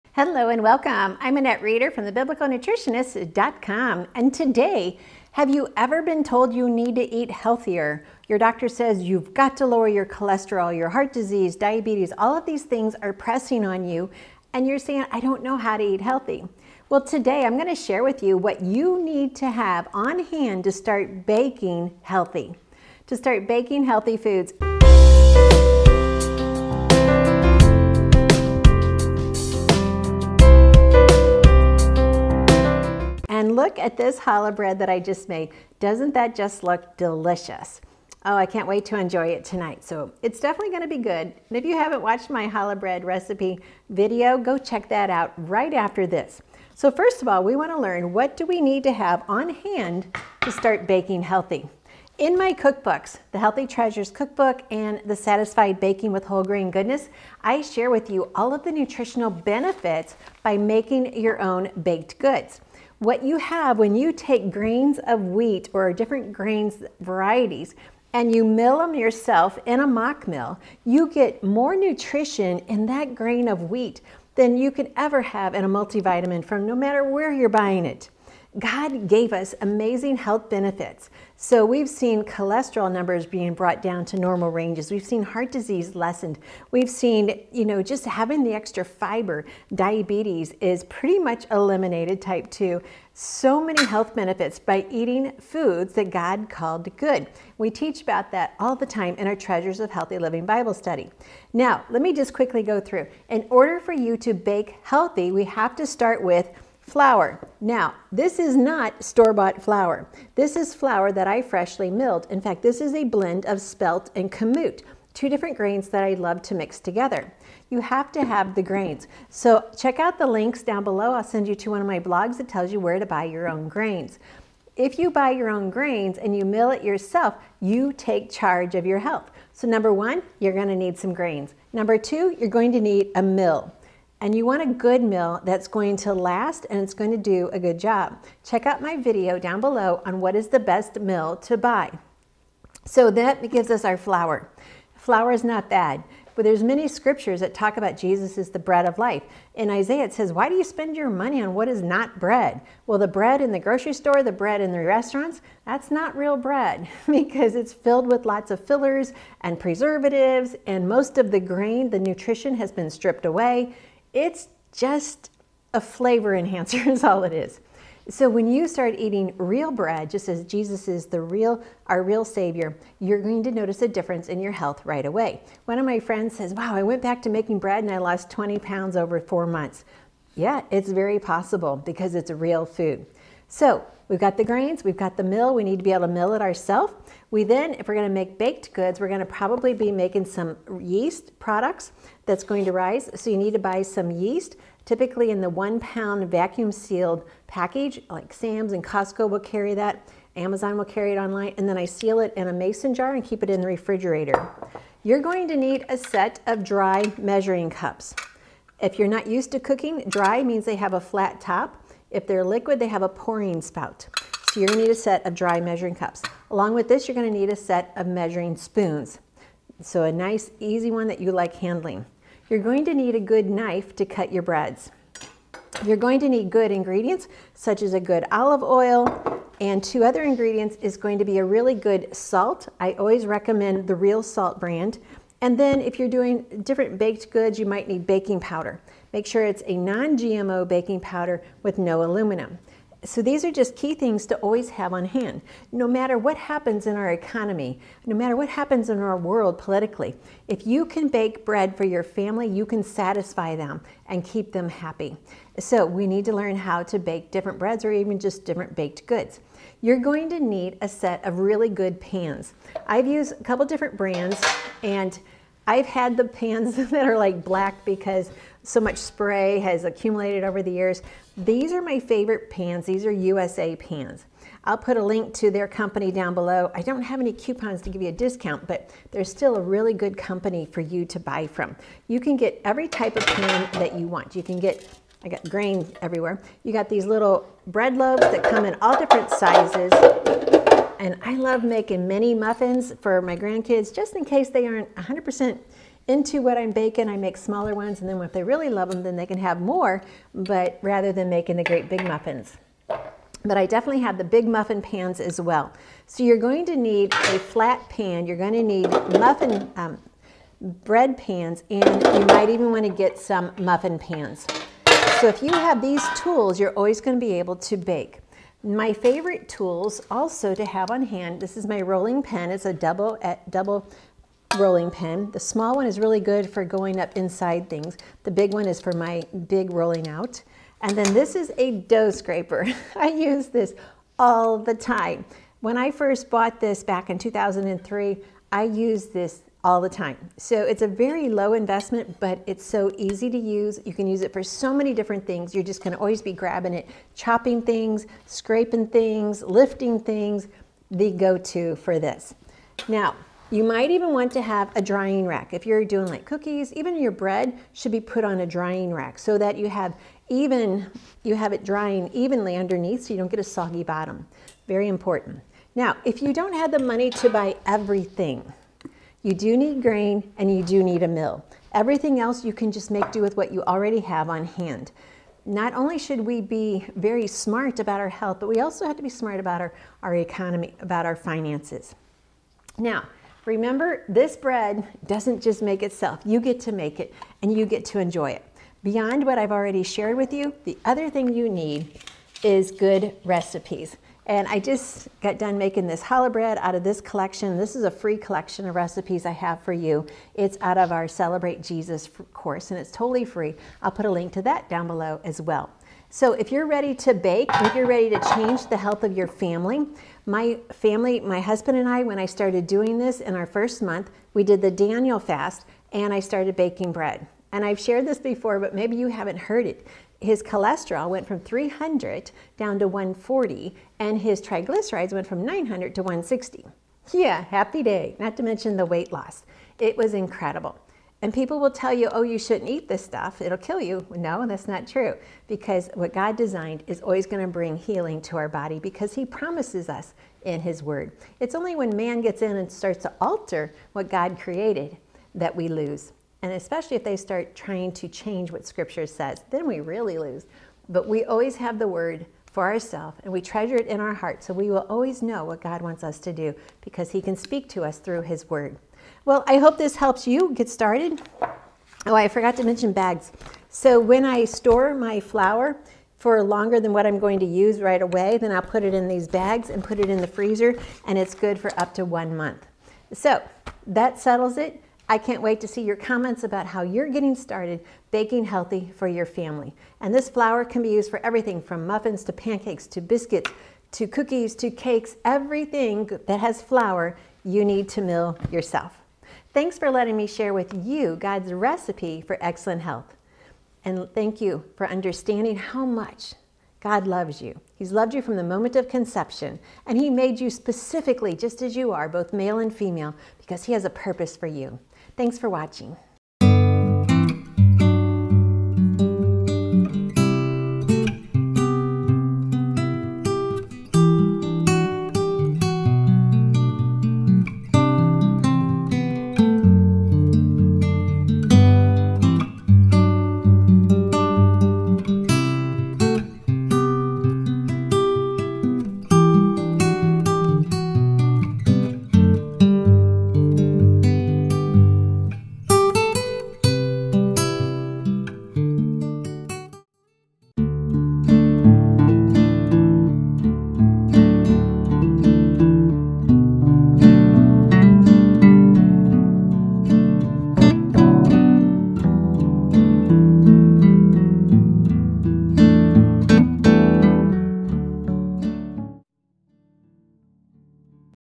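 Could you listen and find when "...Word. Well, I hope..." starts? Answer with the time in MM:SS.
07:38.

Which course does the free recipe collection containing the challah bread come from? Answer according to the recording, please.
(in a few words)
Celebrate Jesus.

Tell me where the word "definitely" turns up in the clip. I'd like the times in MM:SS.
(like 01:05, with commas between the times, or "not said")
00:40, 05:03.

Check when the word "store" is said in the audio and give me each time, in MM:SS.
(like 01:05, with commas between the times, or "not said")
01:49, 02:33, 07:44.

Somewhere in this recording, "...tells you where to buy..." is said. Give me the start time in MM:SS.
02:02.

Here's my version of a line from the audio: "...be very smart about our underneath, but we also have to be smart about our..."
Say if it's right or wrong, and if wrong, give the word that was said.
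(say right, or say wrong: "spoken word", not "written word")
wrong: "health", not "underneath".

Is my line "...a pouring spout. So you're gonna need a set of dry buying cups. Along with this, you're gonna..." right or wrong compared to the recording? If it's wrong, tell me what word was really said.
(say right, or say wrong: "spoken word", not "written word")
wrong: "measuring", not "buying".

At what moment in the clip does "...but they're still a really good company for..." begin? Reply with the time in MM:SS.
04:38.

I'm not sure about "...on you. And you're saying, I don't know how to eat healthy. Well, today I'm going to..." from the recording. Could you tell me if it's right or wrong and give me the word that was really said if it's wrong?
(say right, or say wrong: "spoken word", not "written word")
right.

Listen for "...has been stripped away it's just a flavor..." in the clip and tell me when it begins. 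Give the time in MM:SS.
02:42.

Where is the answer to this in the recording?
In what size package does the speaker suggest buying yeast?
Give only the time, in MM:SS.
03:15.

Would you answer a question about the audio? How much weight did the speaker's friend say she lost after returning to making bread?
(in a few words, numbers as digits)
20 pounds.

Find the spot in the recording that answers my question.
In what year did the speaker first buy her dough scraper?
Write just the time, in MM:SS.
05:37.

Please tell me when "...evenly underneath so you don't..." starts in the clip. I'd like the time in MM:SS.
06:02.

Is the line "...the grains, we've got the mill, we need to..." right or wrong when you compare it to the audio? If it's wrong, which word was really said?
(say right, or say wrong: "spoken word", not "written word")
right.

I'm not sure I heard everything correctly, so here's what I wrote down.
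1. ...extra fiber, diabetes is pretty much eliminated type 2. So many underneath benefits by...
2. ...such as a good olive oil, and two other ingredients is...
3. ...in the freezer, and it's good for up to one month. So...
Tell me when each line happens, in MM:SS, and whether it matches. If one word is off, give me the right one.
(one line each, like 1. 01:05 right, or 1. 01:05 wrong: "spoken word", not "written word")
1. 01:28 wrong: "health", not "underneath"
2. 03:47 right
3. 07:50 right.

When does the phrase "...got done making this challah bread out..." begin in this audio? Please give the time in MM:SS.
06:35.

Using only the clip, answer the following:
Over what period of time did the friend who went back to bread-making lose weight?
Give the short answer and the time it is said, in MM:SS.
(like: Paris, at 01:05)
4 months, at 02:59.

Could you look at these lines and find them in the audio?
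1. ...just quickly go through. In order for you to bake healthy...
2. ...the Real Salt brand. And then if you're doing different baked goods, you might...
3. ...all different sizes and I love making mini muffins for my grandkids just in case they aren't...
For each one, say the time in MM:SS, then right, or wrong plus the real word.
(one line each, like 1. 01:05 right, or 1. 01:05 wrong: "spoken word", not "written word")
1. 01:42 right
2. 03:53 right
3. 04:48 right.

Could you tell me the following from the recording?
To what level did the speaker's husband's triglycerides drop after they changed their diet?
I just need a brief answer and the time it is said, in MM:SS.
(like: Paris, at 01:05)
160, at 07:06.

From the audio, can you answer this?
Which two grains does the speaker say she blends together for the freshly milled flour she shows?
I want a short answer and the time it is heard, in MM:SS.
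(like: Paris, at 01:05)
spelt and kamut, at 01:53.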